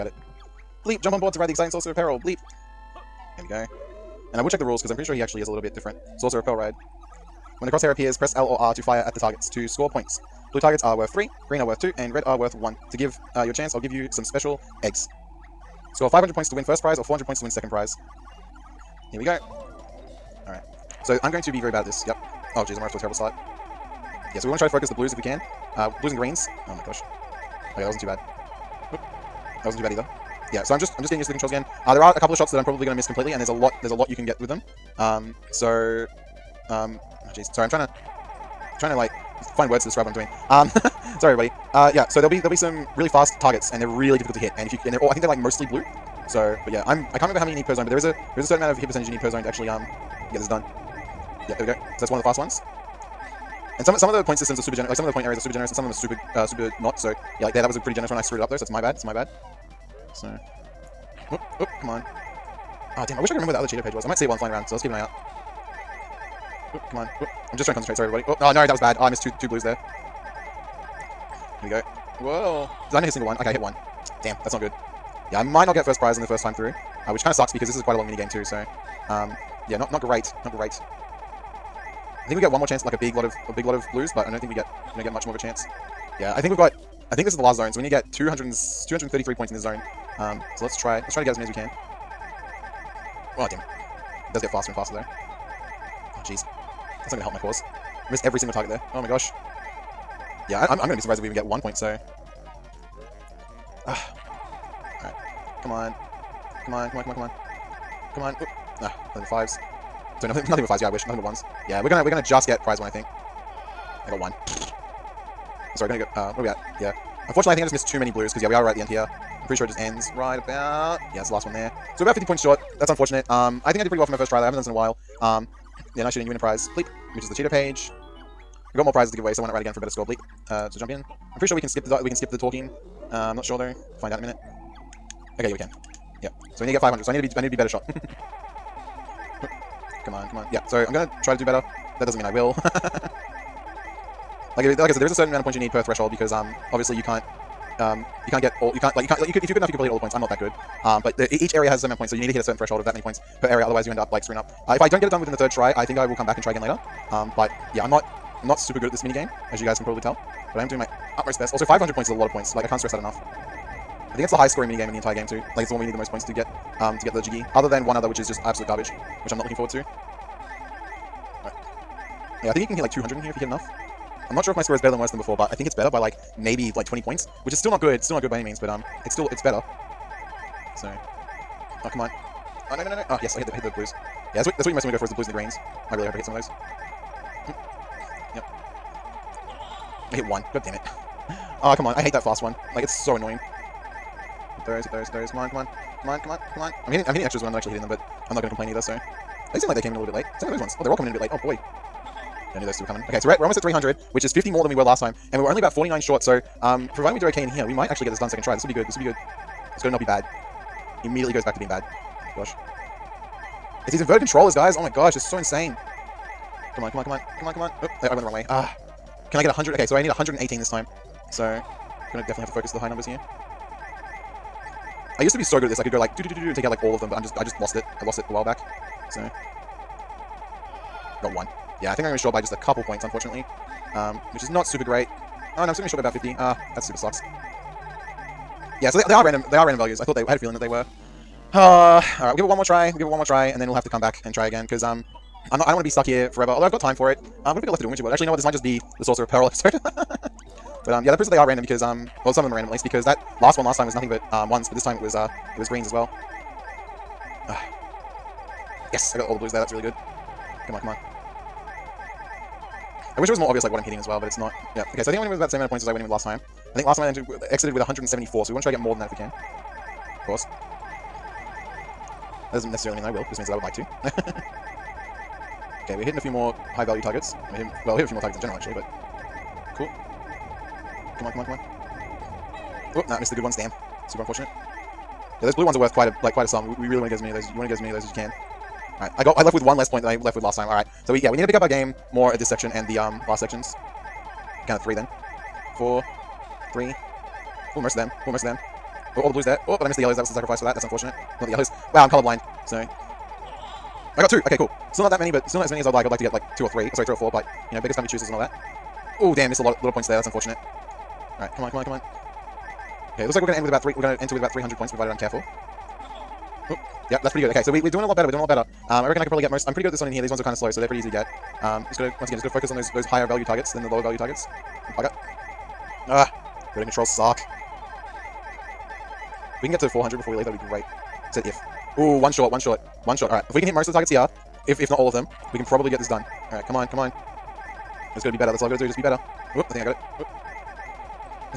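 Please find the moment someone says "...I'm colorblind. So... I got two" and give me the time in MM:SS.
05:02.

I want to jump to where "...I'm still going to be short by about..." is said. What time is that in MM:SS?
03:55.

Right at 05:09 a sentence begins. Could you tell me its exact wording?
Oh, damn, missed a lot of little points there.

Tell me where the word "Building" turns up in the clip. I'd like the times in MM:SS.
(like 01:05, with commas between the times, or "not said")
05:26.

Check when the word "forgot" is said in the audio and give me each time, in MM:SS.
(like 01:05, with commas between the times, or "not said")
not said.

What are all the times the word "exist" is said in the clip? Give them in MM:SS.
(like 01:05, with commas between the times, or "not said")
not said.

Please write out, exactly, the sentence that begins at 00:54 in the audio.
Like some of the point areas are super generous, and some of them are super uh, super not.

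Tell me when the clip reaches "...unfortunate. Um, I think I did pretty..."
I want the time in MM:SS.
02:02.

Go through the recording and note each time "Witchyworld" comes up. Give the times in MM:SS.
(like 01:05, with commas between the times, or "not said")
04:07.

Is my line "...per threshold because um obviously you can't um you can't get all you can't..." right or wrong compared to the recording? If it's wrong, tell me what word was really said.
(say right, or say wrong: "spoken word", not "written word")
right.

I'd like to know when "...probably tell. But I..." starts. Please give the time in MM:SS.
02:39.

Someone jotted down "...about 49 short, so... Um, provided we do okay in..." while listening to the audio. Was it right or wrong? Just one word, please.
right.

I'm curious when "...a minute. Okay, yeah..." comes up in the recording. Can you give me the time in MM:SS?
02:14.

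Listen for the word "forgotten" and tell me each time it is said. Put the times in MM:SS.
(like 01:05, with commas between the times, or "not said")
not said.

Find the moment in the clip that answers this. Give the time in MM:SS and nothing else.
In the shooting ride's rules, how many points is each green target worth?
00:11.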